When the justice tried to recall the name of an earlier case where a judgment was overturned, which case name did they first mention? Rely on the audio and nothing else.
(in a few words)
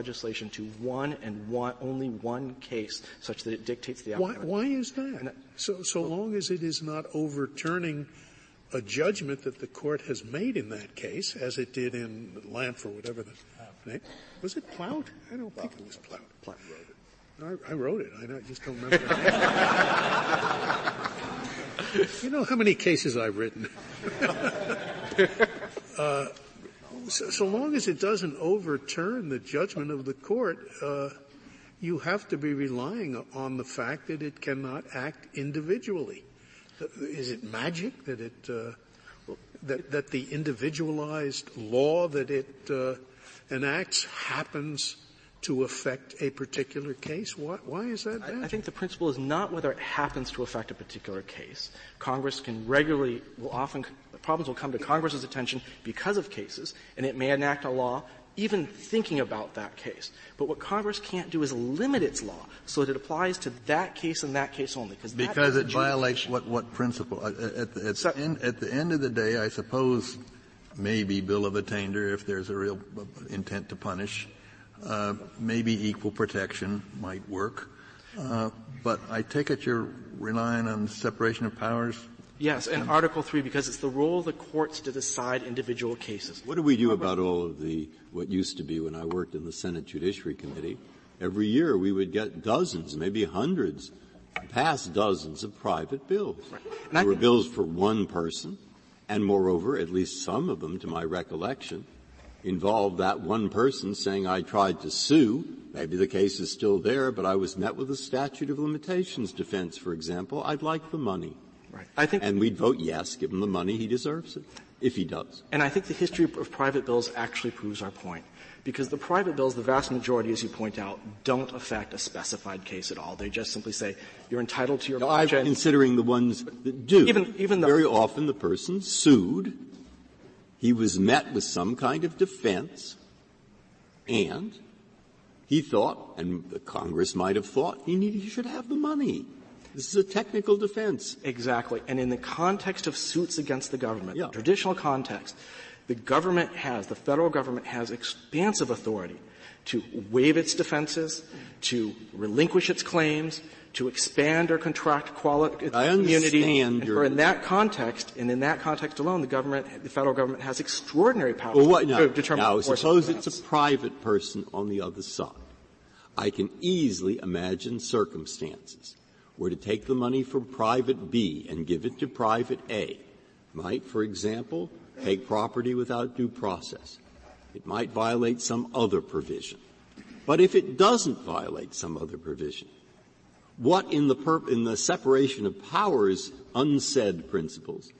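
Lampf.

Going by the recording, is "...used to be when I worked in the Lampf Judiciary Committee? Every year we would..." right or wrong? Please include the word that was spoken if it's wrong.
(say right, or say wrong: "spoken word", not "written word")
wrong: "Senate", not "Lampf".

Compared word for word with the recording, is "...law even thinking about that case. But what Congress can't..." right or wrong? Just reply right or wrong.
right.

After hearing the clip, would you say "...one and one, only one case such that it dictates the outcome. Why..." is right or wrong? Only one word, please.
right.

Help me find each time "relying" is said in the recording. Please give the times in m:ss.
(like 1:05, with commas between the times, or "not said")
0:32, 1:20.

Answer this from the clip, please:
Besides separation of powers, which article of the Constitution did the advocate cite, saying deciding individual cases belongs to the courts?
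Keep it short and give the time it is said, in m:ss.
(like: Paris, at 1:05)
Article 3, at 1:22.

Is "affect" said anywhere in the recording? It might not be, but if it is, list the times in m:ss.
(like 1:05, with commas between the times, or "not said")
0:45, 0:50, 2:01.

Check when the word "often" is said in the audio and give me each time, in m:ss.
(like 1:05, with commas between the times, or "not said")
0:53, 2:07.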